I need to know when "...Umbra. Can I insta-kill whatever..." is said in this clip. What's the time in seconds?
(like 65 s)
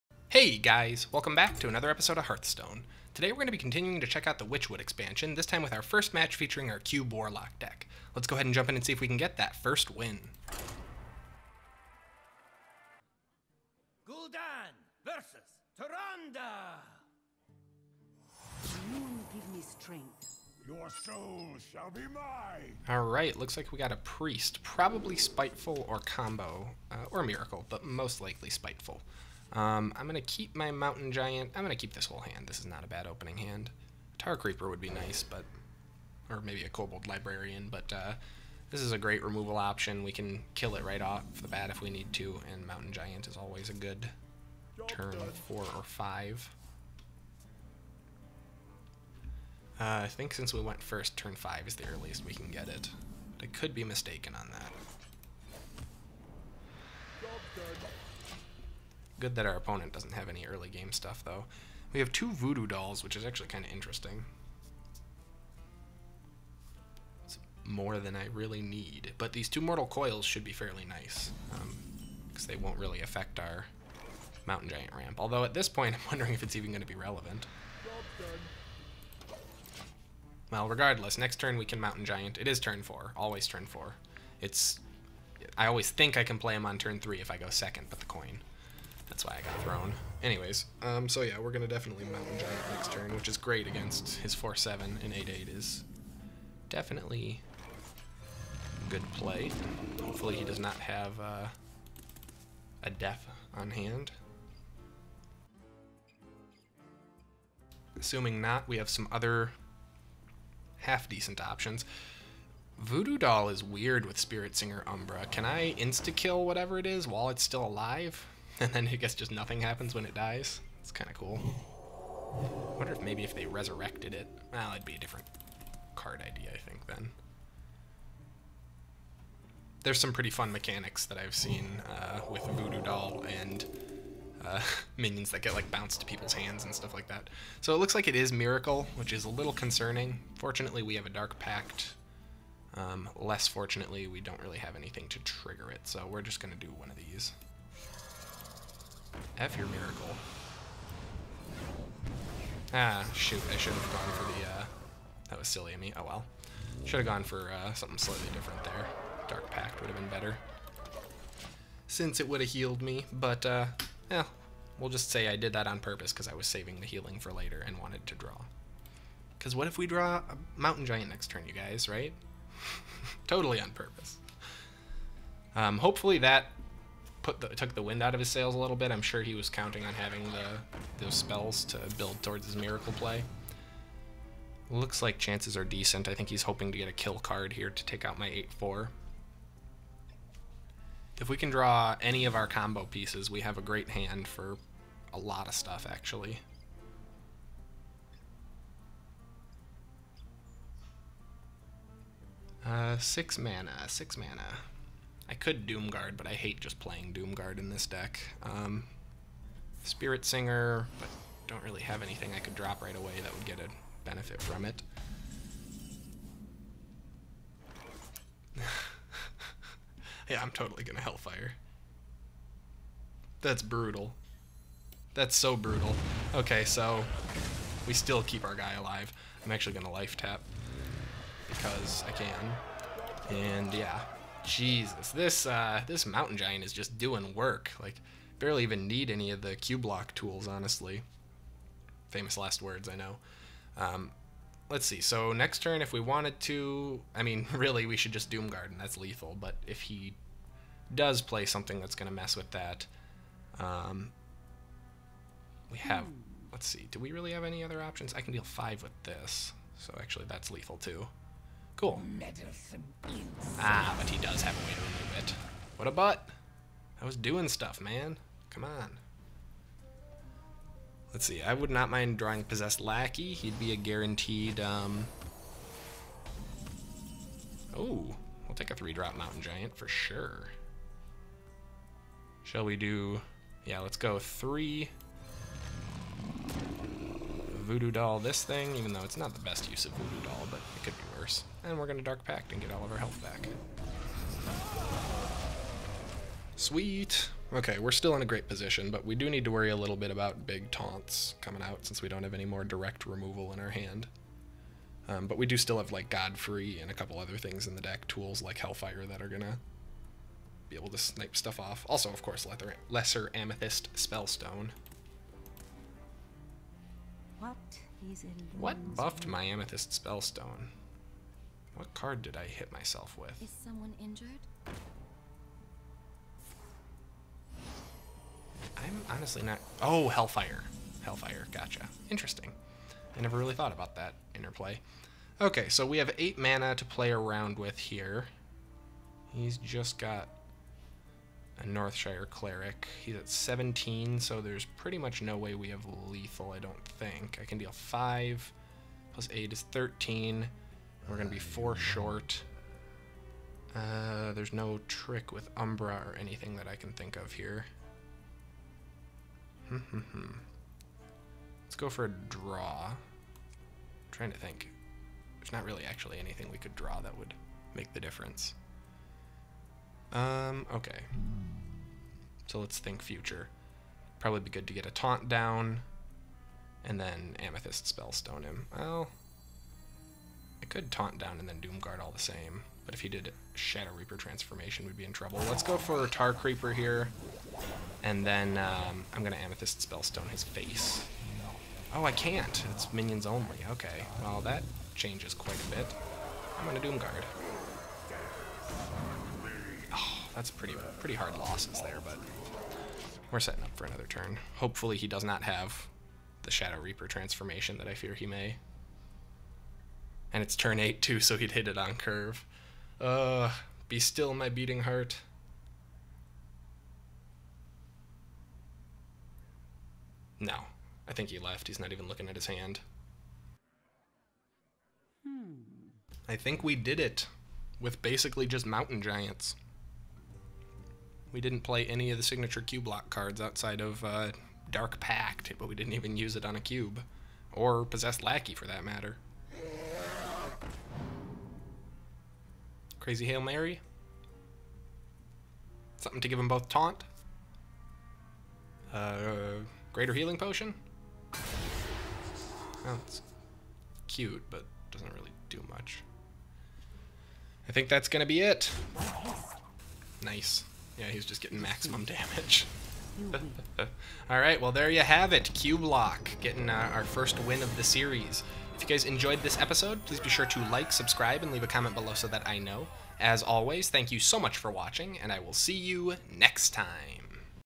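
114 s.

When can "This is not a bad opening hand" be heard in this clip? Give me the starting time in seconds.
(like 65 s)
32 s.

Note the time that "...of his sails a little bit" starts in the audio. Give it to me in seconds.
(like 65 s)
178 s.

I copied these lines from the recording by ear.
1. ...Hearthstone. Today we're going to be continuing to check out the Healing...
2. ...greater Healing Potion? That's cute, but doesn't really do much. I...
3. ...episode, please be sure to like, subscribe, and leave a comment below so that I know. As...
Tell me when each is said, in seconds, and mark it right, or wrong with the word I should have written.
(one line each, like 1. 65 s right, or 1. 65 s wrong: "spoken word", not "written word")
1. 2 s wrong: "Witchwood", not "Healing"
2. 449 s right
3. 469 s right.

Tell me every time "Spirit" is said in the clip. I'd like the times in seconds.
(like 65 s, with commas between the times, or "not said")
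114 s, 209 s.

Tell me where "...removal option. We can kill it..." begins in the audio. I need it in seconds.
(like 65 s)
39 s.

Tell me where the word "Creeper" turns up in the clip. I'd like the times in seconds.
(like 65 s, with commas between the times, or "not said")
34 s, 386 s.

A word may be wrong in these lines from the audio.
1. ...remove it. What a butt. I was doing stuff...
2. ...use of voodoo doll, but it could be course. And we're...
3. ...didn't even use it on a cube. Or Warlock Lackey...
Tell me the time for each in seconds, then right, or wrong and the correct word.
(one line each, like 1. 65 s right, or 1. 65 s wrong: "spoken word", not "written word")
1. 264 s right
2. 289 s wrong: "worse", not "course"
3. 435 s wrong: "Possessed", not "Warlock".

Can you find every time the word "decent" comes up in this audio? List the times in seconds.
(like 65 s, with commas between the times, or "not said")
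110 s, 185 s.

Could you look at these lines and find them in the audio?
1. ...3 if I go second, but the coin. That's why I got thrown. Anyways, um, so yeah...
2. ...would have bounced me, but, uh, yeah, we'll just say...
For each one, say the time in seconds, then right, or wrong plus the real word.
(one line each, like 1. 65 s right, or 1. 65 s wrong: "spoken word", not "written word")
1. 86 s right
2. 162 s wrong: "healed", not "bounced".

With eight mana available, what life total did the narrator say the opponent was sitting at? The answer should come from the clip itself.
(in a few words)
17.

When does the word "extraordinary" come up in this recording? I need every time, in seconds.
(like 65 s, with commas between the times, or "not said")
not said.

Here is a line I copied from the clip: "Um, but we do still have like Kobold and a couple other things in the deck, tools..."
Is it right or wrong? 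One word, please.
wrong.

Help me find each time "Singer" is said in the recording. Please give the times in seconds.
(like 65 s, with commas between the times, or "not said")
114 s, 210 s.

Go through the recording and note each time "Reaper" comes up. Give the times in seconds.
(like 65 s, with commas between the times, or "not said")
383 s, 406 s.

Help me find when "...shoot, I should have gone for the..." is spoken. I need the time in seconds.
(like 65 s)
153 s.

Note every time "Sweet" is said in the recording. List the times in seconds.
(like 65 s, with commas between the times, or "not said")
296 s.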